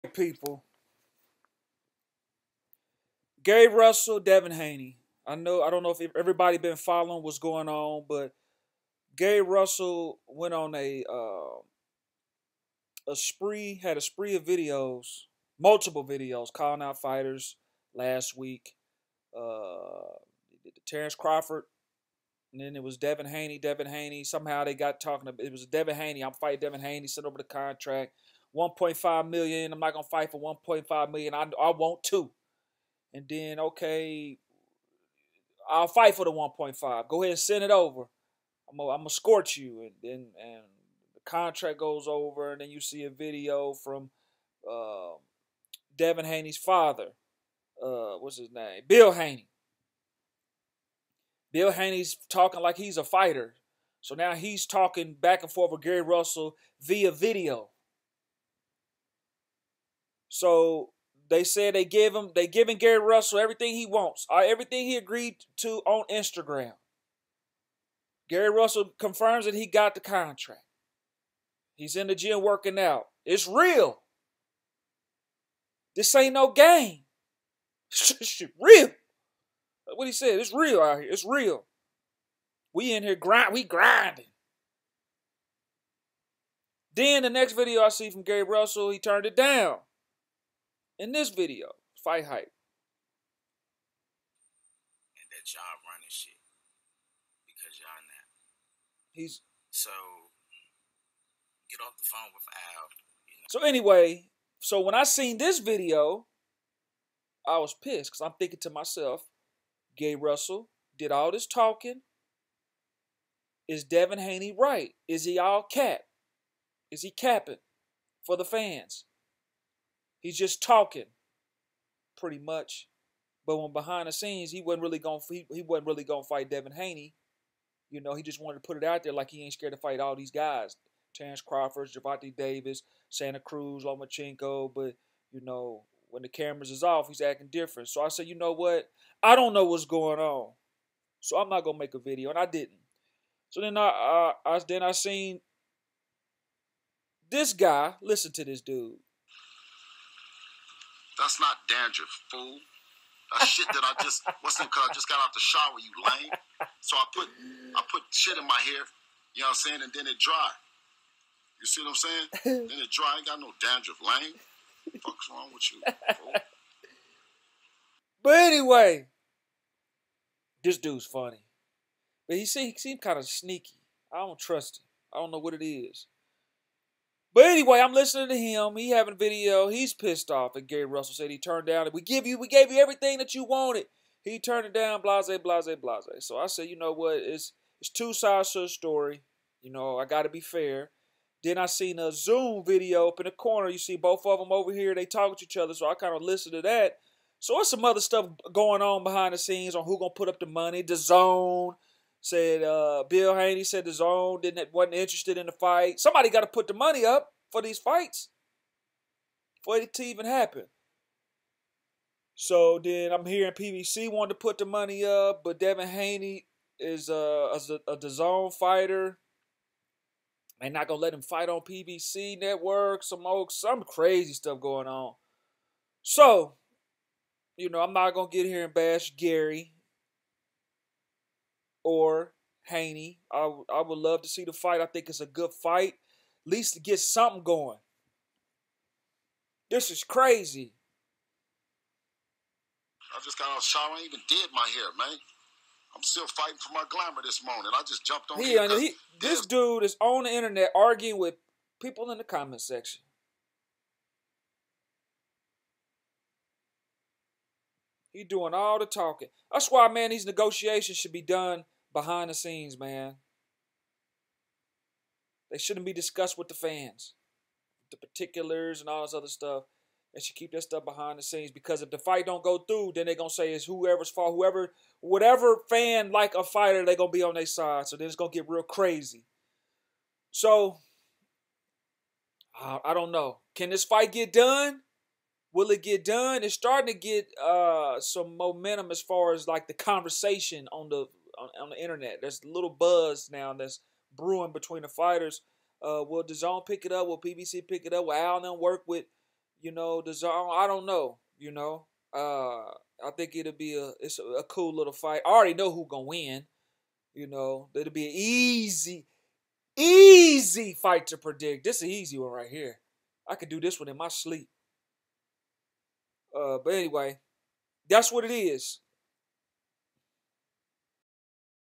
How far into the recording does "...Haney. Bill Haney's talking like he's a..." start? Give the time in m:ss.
0:49.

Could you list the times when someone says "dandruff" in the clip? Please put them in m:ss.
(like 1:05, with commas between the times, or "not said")
2:31, 2:43.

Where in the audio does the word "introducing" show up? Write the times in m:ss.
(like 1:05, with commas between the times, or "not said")
not said.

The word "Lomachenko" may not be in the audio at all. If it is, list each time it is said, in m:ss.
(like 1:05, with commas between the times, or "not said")
2:13.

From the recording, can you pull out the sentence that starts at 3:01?
We give you, we gave you everything that you wanted.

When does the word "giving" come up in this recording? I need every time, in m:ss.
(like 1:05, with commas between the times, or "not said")
1:02.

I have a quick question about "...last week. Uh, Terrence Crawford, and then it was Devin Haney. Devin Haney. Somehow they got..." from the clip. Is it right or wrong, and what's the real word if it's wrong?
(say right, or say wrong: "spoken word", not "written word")
right.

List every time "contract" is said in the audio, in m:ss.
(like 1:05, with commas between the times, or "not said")
0:27, 0:41, 1:09.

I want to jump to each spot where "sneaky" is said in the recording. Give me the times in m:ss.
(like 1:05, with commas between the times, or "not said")
2:53.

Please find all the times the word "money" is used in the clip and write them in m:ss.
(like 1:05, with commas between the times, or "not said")
3:20, 3:26, 3:34.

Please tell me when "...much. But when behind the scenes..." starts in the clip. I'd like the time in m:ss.
2:02.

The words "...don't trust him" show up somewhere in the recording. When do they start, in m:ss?
2:54.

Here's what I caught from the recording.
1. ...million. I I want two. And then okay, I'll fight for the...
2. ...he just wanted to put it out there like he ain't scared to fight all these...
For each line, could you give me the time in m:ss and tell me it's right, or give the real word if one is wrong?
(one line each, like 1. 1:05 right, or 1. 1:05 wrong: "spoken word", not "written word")
1. 0:31 right
2. 2:08 right.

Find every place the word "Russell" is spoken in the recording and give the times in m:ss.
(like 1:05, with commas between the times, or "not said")
0:03, 0:09, 0:56, 1:02, 1:08, 1:28, 1:50, 3:00.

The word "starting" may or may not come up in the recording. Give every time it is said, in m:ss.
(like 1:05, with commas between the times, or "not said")
4:46.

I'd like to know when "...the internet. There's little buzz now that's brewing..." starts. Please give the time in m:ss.
4:51.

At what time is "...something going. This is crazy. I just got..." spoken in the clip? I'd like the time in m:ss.
3:56.